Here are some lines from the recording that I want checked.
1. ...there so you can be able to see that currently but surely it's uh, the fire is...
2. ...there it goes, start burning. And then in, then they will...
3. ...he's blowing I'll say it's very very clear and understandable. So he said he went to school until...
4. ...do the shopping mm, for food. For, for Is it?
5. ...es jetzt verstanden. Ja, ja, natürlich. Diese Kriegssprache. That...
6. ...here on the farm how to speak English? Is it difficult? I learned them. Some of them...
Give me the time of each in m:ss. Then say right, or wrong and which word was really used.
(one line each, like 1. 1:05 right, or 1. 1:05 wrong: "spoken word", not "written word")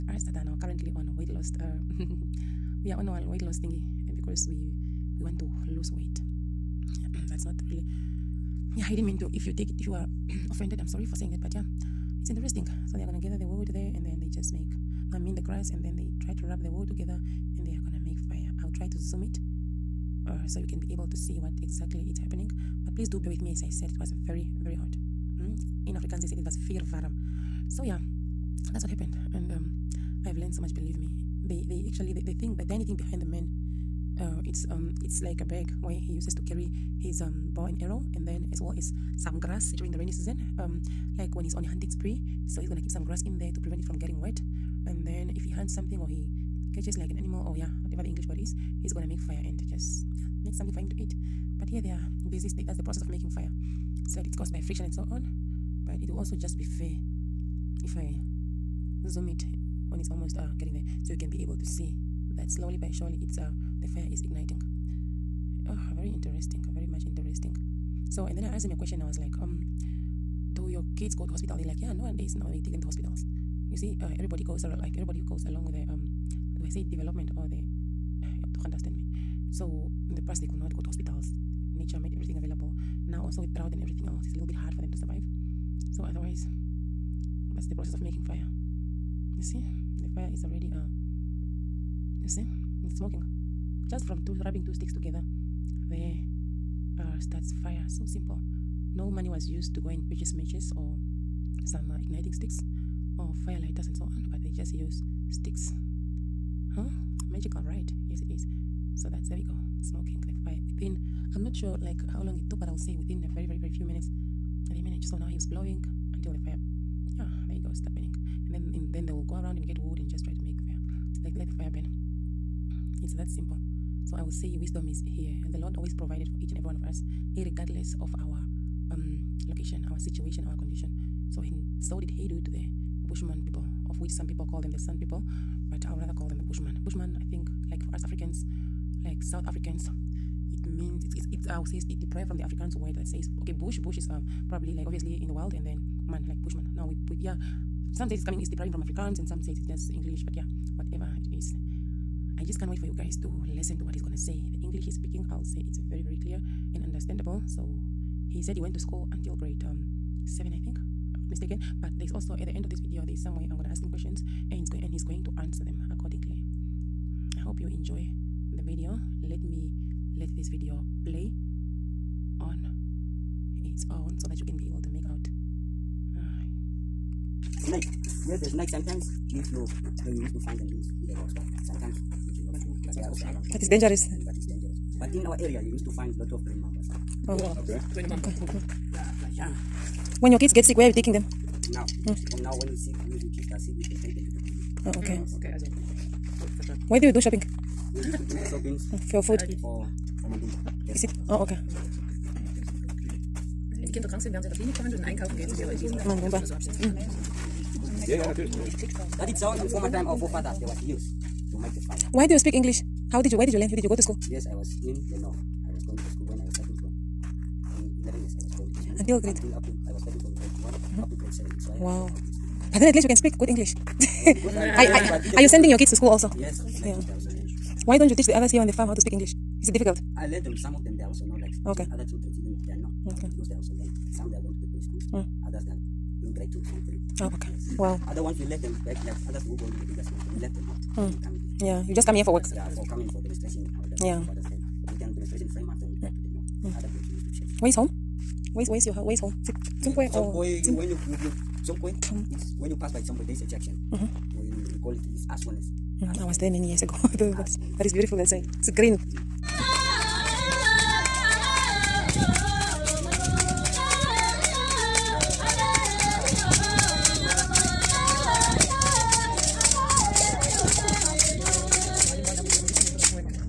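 1. 1:00 wrong: "slowly", not "currently"
2. 1:57 right
3. 2:34 wrong: "speaking", not "blowing"
4. 3:18 right
5. 3:26 right
6. 3:48 right.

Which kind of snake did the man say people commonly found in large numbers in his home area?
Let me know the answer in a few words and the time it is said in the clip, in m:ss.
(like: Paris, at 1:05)
green mambas, at 3:06.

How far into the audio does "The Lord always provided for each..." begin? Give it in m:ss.
2:05.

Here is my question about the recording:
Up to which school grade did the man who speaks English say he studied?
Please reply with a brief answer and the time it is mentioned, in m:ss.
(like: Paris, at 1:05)
grade 7, at 3:41.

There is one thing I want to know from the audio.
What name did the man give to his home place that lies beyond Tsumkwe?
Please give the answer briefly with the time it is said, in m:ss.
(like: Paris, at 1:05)
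Aswanes, at 4:15.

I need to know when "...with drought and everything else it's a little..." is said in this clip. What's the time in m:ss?
1:23.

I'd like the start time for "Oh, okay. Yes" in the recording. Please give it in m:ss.
3:57.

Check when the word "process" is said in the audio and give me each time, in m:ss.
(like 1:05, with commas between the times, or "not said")
0:52, 1:27.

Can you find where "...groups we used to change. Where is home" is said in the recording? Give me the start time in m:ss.
4:06.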